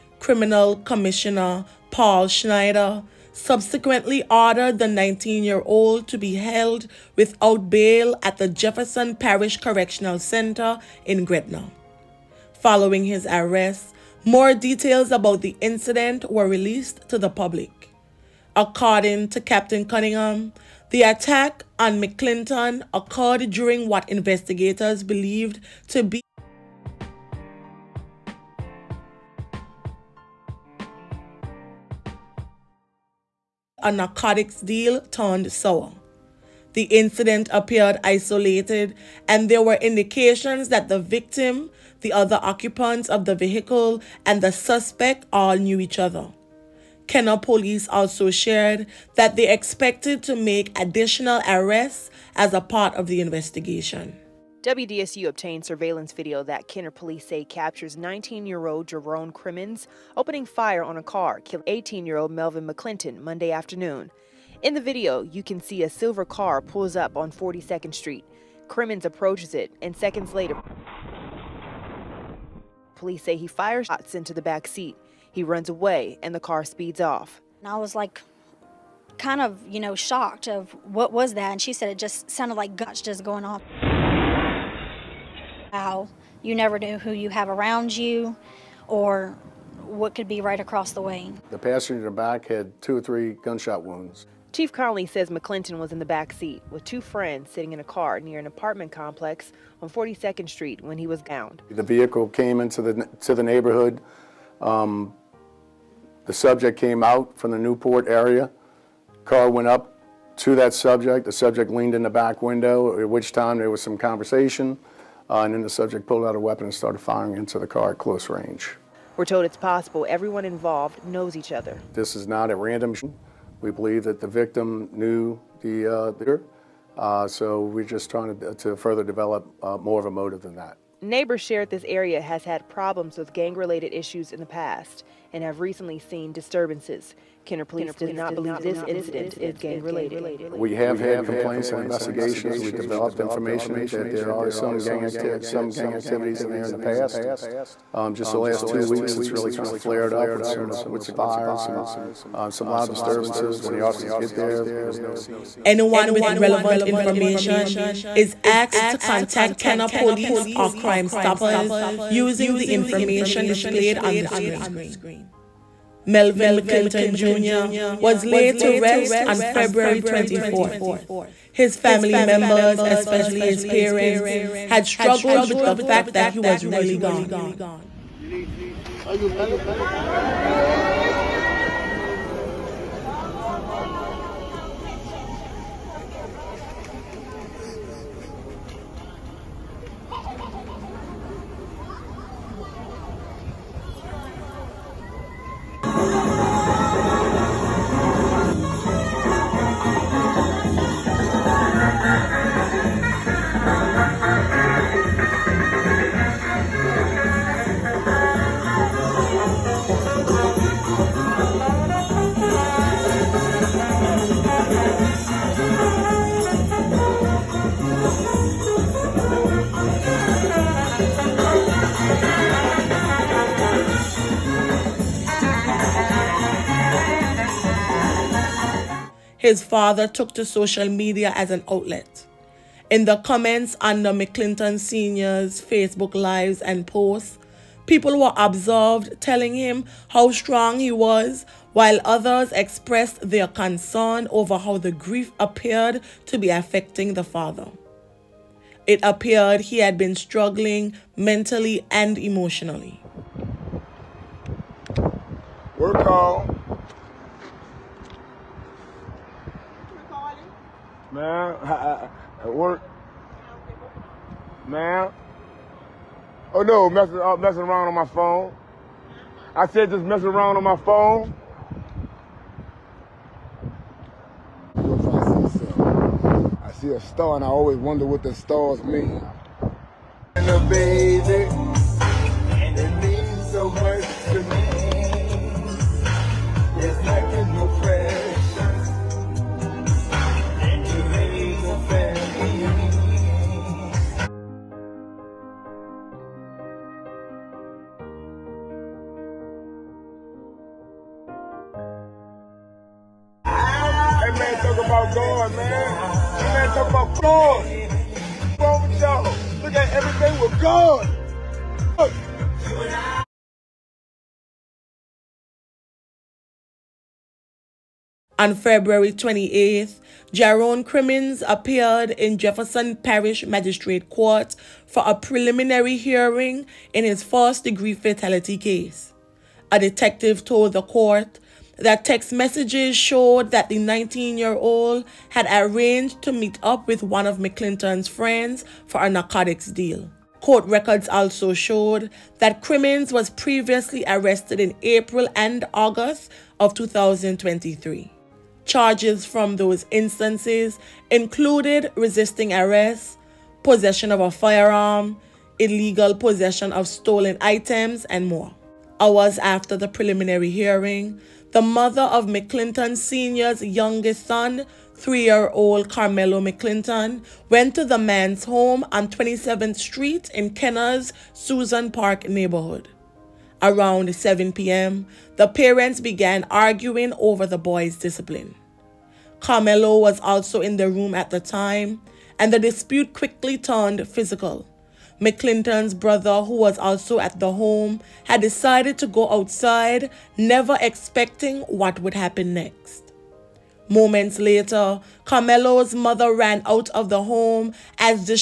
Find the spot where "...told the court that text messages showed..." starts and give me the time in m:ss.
5:30.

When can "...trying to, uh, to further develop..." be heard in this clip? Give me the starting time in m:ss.
2:08.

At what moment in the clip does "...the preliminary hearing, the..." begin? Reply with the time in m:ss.
5:59.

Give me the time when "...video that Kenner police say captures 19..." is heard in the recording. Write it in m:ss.
0:56.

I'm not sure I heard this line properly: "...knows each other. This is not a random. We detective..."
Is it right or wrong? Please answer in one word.
wrong.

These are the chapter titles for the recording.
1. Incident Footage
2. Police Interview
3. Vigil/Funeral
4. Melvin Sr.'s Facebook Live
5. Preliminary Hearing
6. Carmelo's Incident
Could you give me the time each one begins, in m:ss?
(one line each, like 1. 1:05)
1. 1:07
2. 1:37
3. 2:48
4. 4:16
5. 5:19
6. 6:01.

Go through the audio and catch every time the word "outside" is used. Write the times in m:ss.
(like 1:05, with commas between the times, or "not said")
6:29.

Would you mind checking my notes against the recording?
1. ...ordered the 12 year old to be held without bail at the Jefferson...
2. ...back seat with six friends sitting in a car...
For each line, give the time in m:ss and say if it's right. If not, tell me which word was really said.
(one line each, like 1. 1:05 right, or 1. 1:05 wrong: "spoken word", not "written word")
1. 0:04 wrong: "19", not "12"
2. 1:36 wrong: "two", not "six".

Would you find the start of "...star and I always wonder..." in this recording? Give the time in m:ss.
4:37.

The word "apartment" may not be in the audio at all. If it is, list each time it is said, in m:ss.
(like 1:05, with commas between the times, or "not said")
1:38.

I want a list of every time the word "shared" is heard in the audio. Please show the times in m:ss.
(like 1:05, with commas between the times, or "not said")
0:48, 2:11.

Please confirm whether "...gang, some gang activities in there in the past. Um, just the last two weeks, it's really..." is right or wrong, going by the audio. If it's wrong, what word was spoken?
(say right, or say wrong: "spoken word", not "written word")
right.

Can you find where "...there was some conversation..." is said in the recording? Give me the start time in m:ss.
1:53.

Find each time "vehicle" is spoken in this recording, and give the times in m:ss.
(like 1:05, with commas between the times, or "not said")
0:43, 1:41.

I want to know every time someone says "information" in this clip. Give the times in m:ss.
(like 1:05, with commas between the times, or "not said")
2:23, 2:36, 2:42.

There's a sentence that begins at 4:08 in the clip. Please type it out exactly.
It appeared he had been struggling mentally and emotionally.